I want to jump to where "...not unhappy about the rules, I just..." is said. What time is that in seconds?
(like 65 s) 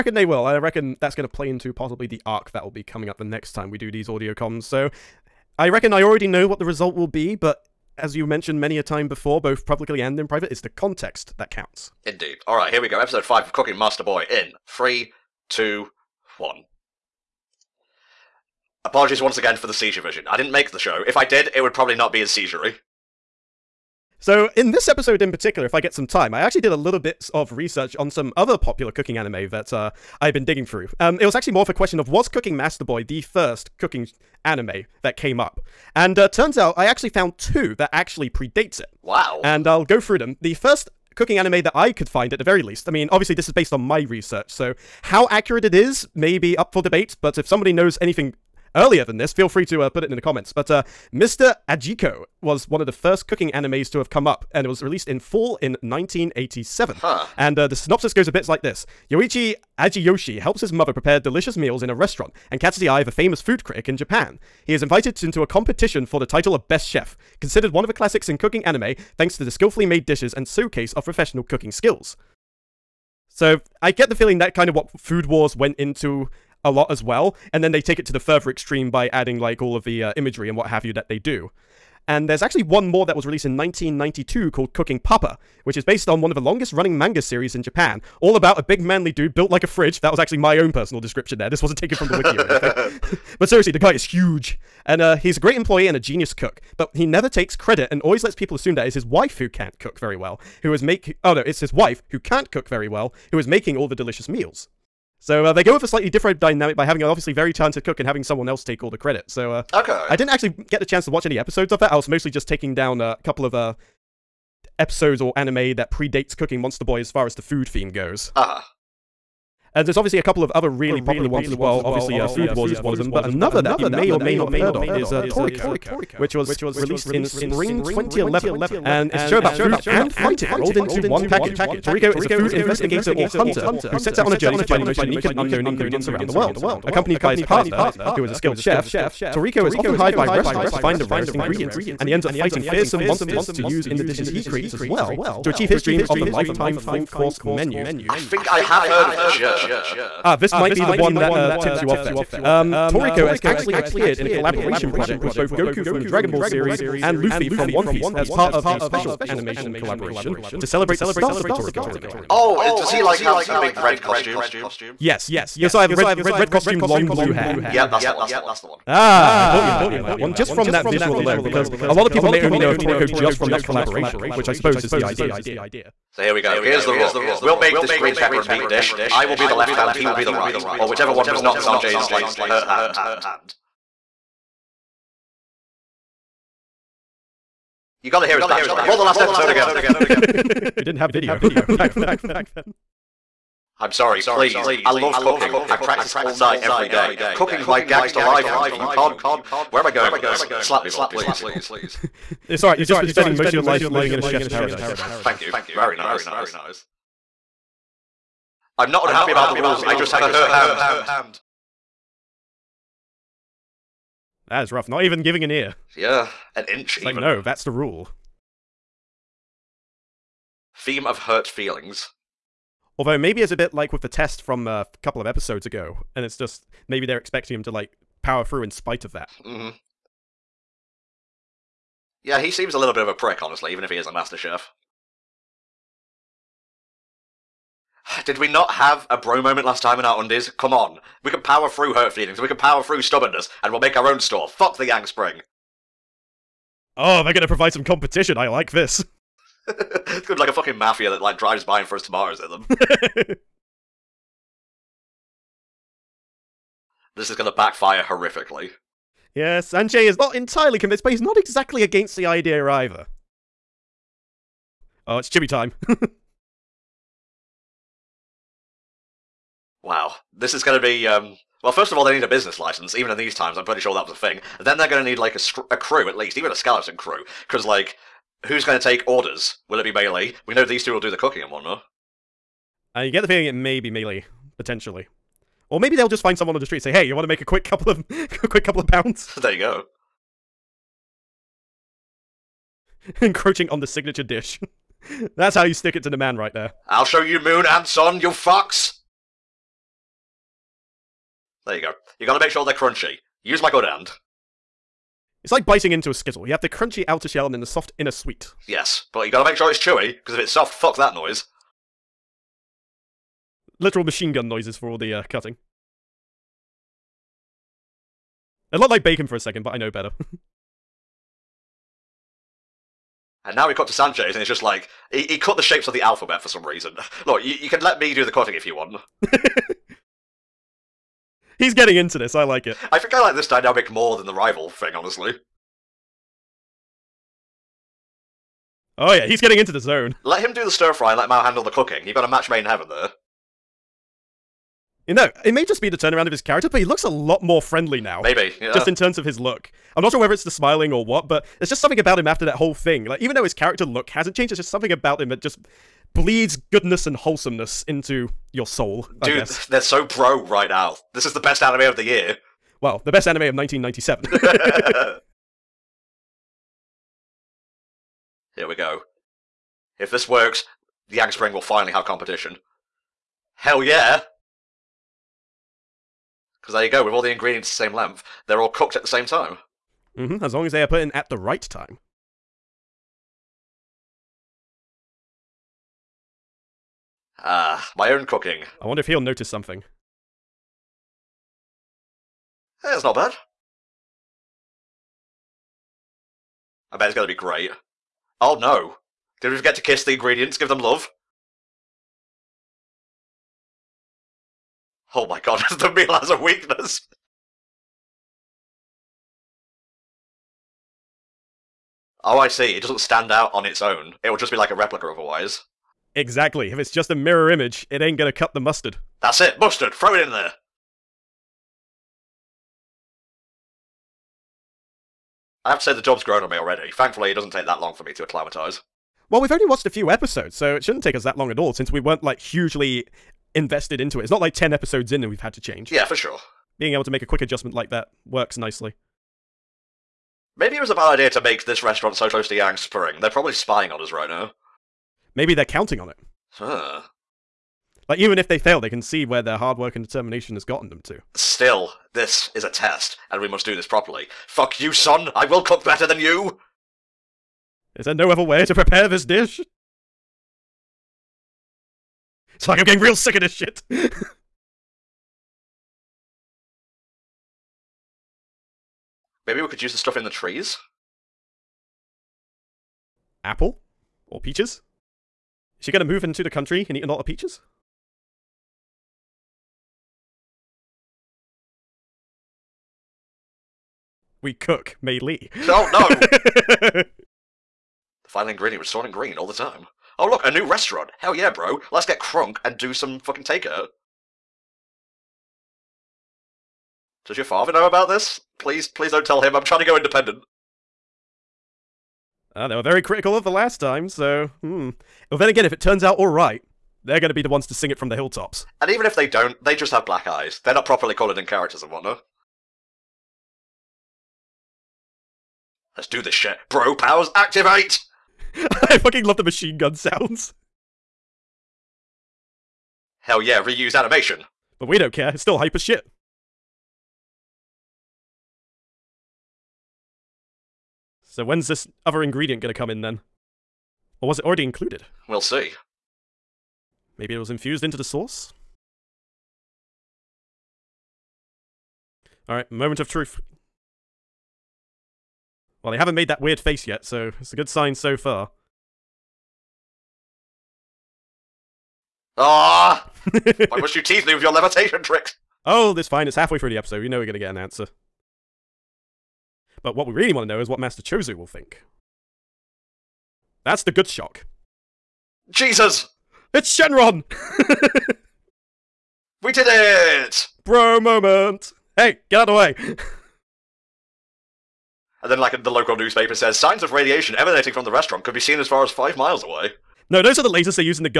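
208 s.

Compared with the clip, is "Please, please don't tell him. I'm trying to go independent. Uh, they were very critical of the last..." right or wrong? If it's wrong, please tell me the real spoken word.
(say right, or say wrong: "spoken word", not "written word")
right.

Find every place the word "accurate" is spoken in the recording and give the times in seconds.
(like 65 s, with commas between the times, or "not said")
45 s.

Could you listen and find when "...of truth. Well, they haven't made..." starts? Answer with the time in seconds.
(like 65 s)
542 s.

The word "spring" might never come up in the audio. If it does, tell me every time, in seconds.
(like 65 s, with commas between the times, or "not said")
127 s, 245 s, 371 s, 442 s.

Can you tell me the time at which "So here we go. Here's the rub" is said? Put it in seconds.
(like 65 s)
176 s.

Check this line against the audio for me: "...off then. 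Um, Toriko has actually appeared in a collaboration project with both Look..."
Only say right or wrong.
wrong.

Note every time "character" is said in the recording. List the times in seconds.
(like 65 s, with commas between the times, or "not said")
346 s, 353 s, 511 s.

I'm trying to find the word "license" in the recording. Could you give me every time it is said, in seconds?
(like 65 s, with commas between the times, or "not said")
272 s.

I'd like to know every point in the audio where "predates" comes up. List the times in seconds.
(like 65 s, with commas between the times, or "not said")
38 s, 115 s.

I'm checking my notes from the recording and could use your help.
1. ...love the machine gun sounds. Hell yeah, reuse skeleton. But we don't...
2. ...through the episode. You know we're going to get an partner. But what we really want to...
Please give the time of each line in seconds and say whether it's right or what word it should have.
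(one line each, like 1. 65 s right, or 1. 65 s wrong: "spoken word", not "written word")
1. 519 s wrong: "animation", not "skeleton"
2. 556 s wrong: "answer", not "partner".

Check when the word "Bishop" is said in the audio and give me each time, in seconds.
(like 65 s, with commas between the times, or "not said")
not said.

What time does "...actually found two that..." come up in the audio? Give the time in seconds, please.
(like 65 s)
36 s.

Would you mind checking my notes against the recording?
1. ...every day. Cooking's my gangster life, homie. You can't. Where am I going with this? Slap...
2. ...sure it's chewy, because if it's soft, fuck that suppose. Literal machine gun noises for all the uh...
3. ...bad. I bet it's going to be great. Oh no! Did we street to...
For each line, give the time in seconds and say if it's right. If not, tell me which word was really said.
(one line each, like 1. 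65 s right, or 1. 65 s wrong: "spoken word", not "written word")
1. 196 s right
2. 309 s wrong: "noise", not "suppose"
3. 393 s wrong: "forget", not "street".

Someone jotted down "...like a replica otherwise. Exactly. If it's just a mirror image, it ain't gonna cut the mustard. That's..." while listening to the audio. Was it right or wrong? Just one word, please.
right.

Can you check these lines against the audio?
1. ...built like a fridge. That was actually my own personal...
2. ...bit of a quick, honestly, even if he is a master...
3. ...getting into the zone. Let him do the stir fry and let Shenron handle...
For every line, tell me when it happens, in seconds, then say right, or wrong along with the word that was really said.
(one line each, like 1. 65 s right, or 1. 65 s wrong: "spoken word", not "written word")
1. 89 s right
2. 232 s wrong: "prick", not "quick"
3. 339 s wrong: "Mao", not "Shenron".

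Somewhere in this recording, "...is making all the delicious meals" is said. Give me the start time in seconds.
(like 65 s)
103 s.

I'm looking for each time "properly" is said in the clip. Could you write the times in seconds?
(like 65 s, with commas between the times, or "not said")
453 s, 510 s.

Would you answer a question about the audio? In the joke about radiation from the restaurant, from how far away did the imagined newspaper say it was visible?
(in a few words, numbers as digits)
5 miles.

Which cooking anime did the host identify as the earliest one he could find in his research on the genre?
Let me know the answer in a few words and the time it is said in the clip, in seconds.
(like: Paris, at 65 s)
Mr. Ajikko, at 51 s.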